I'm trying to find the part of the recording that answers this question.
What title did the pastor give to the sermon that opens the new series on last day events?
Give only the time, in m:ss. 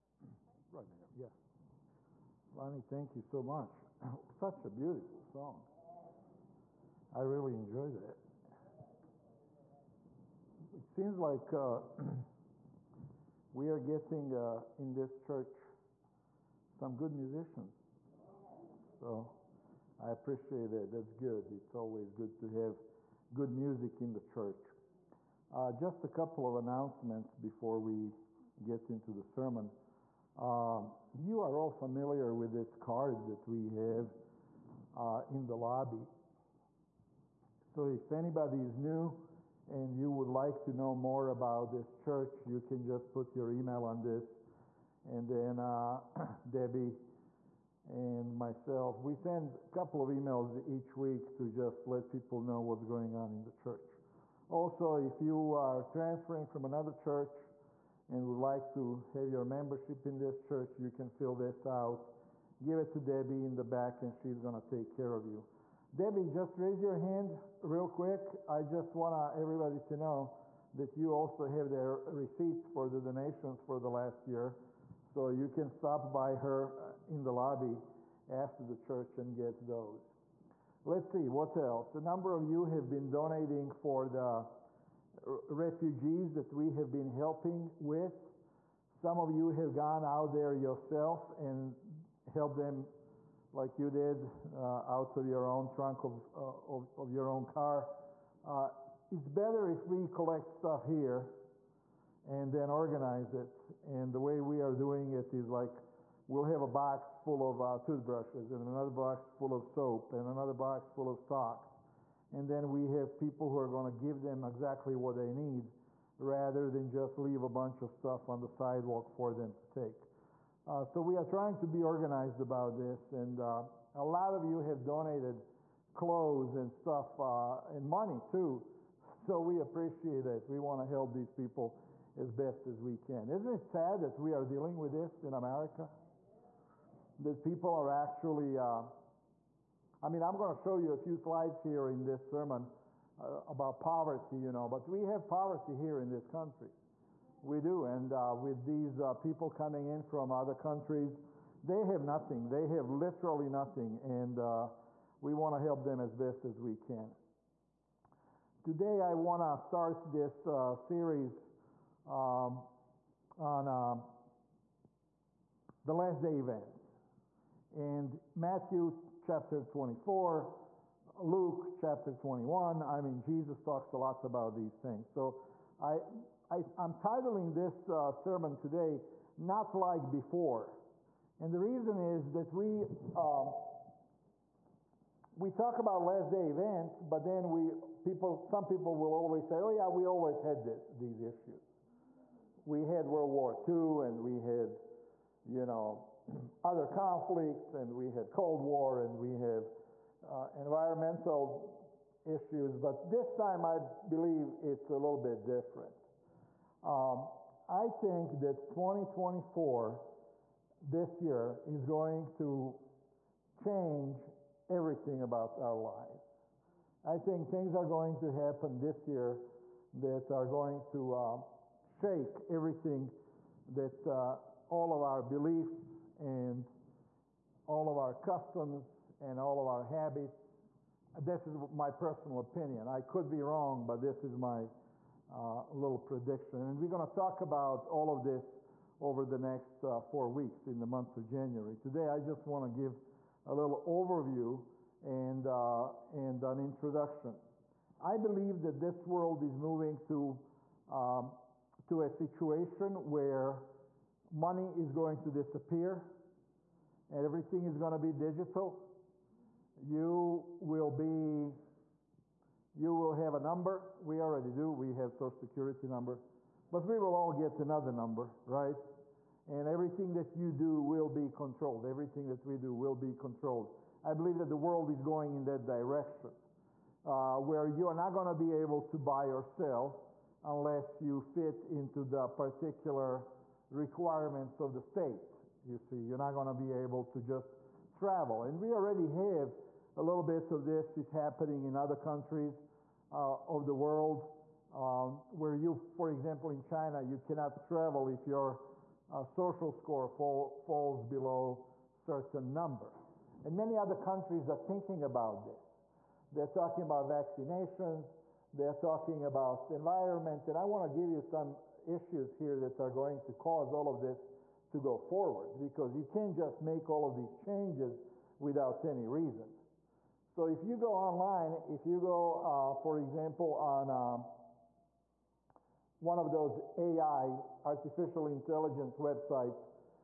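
2:59.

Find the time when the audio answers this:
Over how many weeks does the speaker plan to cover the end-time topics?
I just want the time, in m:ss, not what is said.
3:59.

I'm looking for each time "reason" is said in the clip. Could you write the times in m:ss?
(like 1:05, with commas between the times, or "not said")
3:01, 5:19.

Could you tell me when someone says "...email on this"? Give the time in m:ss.
0:43.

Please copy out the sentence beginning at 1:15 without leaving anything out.
So you can stop by her uh, in the lobby after the church and get those.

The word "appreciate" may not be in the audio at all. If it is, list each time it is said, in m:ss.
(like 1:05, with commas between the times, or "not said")
0:20, 2:09.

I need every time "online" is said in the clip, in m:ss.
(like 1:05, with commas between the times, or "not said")
5:20.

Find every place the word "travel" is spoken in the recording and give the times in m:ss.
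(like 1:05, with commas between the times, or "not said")
4:47, 4:57.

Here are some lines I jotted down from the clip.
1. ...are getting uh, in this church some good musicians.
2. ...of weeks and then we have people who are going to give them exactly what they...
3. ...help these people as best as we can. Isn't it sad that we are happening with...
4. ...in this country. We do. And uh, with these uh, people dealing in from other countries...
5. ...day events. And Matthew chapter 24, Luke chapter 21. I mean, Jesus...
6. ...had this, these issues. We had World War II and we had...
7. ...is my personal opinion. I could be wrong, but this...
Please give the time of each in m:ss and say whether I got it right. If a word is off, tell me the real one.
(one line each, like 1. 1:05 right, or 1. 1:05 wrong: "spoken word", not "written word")
1. 0:13 right
2. 1:51 wrong: "socks", not "weeks"
3. 2:10 wrong: "dealing", not "happening"
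4. 2:25 wrong: "coming", not "dealing"
5. 2:46 right
6. 3:10 right
7. 3:51 right.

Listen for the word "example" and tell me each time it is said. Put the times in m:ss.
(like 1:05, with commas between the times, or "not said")
4:56, 5:22.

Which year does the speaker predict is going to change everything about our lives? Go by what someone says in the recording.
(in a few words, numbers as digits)
2024.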